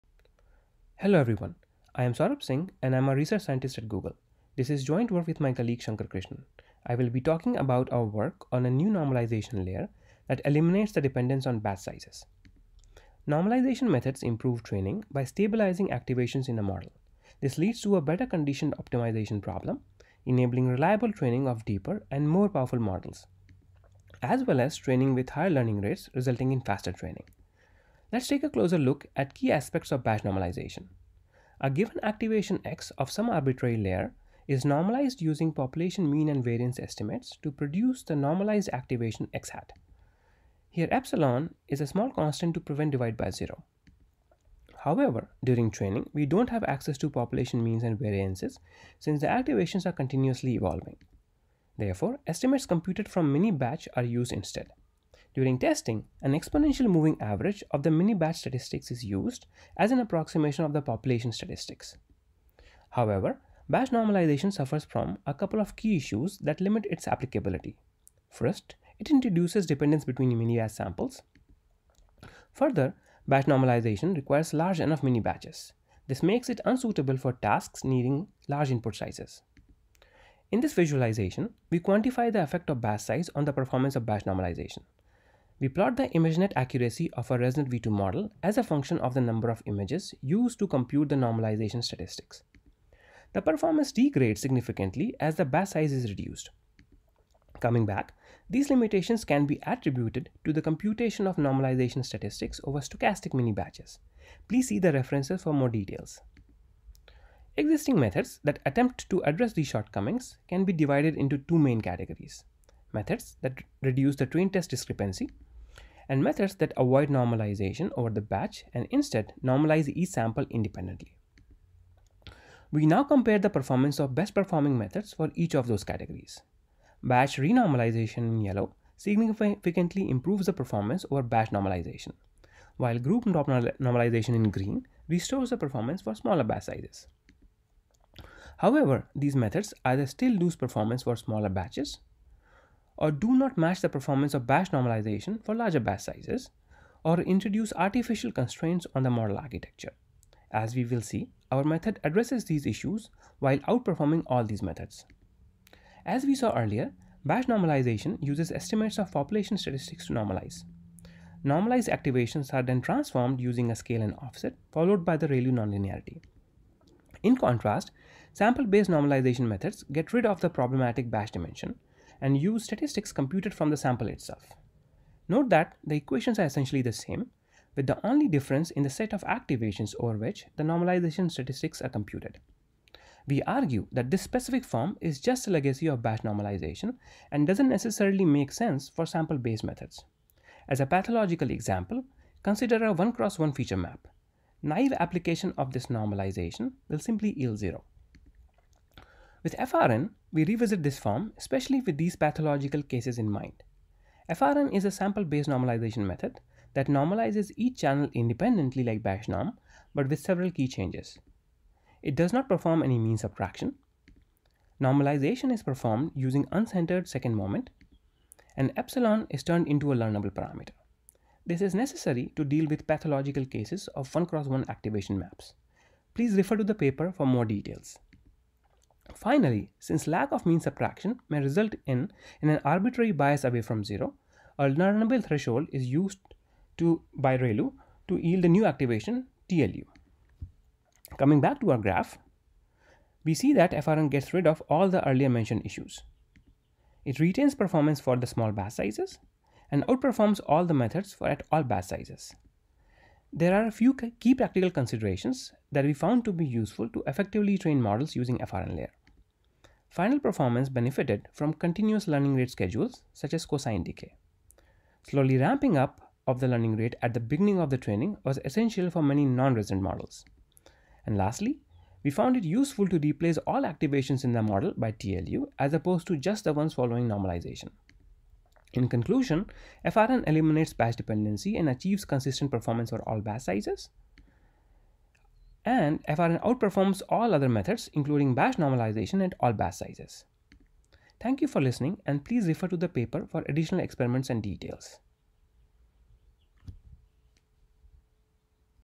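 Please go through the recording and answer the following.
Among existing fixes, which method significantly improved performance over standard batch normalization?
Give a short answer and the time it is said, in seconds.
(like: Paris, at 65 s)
Batch renormalization, at 127 s.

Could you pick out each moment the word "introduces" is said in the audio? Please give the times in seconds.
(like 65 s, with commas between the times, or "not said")
69 s, 147 s.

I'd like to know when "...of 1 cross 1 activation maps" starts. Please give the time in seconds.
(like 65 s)
223 s.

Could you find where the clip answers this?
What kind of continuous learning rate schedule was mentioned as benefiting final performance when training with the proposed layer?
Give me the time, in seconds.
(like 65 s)
263 s.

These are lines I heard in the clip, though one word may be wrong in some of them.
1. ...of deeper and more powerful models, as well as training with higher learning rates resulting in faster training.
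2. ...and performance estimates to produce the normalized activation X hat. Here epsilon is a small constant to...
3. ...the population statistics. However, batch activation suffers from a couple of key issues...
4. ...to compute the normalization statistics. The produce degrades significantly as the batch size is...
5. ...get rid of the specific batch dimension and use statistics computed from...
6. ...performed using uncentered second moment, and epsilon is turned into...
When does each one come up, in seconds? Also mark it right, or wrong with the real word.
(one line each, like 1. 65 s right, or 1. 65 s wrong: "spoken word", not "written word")
1. 21 s right
2. 36 s wrong: "variance", not "performance"
3. 60 s wrong: "normalization", not "activation"
4. 90 s wrong: "performance", not "produce"
5. 169 s wrong: "problematic", not "specific"
6. 215 s right.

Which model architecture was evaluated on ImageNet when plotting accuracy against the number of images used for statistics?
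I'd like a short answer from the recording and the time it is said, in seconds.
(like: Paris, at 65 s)
ResNet V2, at 87 s.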